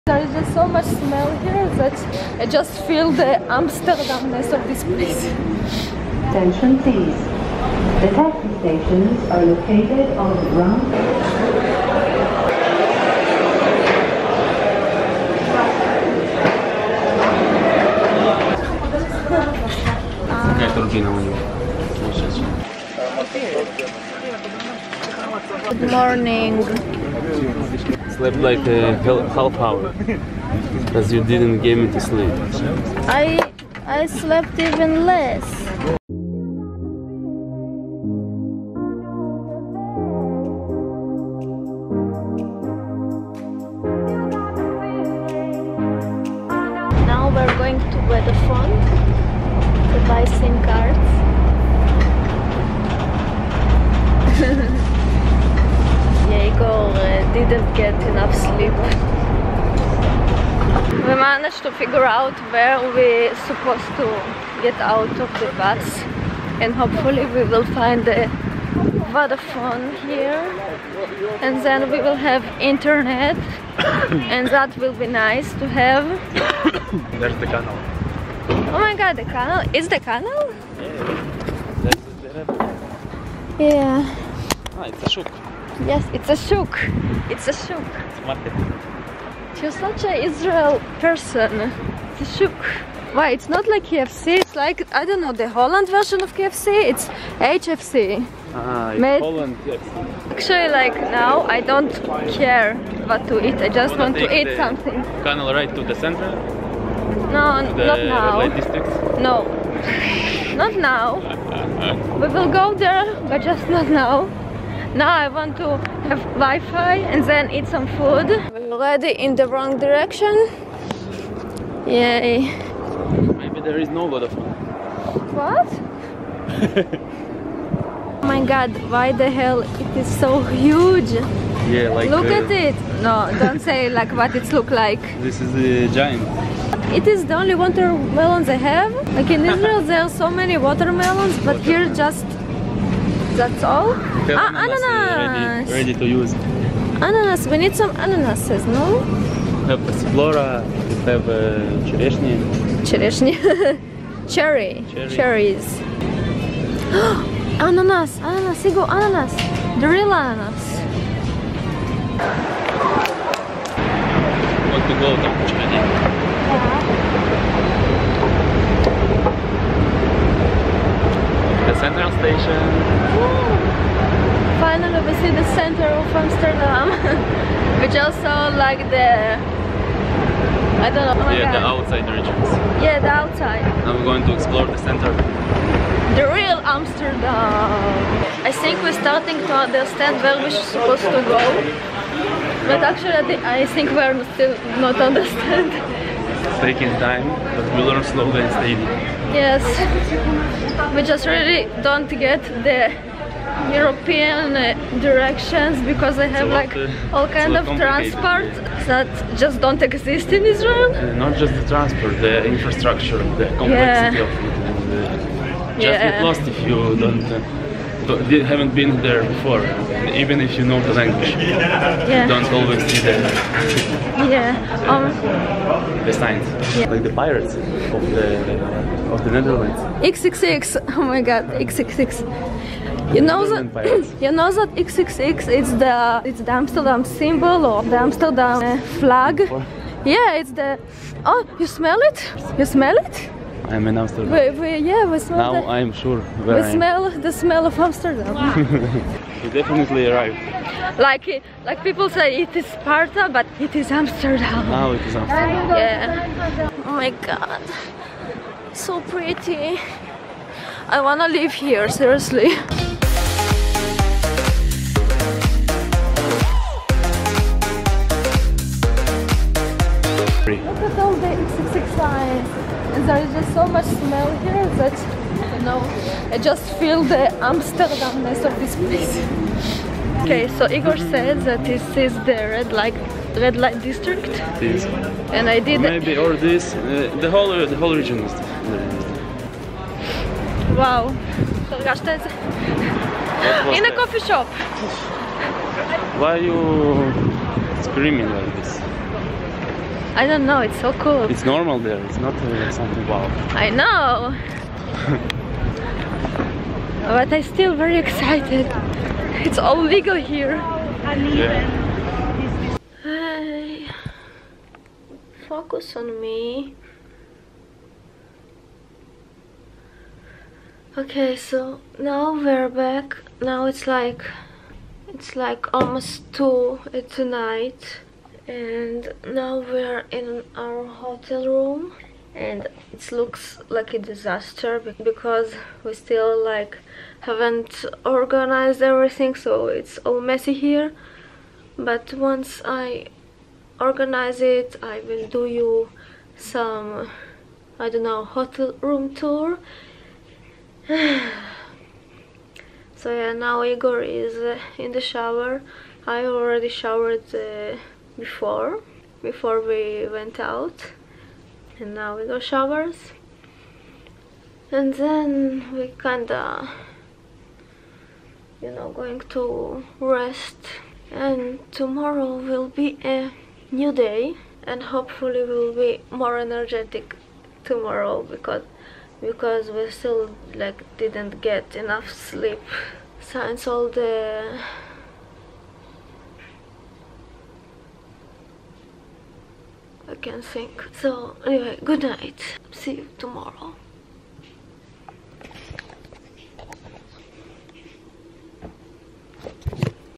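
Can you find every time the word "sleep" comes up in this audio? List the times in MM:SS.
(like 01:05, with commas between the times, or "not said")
00:32, 00:58, 06:22.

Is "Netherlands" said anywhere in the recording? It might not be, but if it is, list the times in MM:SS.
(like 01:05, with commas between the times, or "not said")
03:49.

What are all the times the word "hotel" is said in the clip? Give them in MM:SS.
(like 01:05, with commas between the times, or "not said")
05:30, 05:48.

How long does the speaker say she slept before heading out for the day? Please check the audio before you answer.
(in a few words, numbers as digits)
half hour.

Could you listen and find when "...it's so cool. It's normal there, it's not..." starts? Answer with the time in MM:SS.
05:00.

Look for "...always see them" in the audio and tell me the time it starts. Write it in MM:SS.
03:42.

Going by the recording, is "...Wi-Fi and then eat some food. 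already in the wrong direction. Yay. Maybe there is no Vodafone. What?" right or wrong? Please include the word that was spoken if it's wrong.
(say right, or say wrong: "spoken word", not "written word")
right.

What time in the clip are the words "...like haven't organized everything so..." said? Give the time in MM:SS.
05:36.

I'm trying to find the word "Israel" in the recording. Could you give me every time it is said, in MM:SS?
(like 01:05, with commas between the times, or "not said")
01:30, 02:19, 03:30.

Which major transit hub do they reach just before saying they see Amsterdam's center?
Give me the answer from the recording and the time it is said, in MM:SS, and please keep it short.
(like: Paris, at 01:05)
Central Station, at 02:51.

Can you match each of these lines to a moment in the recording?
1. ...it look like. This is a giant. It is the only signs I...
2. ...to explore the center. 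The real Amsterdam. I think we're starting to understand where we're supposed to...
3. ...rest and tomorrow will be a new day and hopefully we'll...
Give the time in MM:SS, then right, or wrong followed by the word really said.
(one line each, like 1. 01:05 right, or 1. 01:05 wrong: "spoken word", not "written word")
1. 02:14 wrong: "watermelons", not "signs"
2. 03:04 right
3. 06:09 right.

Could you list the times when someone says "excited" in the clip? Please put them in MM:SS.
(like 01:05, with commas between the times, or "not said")
05:07.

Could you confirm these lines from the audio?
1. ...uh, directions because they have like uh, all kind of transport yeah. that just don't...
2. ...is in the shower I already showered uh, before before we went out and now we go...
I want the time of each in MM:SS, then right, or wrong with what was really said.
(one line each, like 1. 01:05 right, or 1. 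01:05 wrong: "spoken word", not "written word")
1. 03:24 right
2. 05:54 right.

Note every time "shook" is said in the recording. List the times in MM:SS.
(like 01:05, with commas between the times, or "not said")
01:25.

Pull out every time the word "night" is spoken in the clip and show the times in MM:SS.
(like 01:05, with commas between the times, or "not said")
05:27, 06:32.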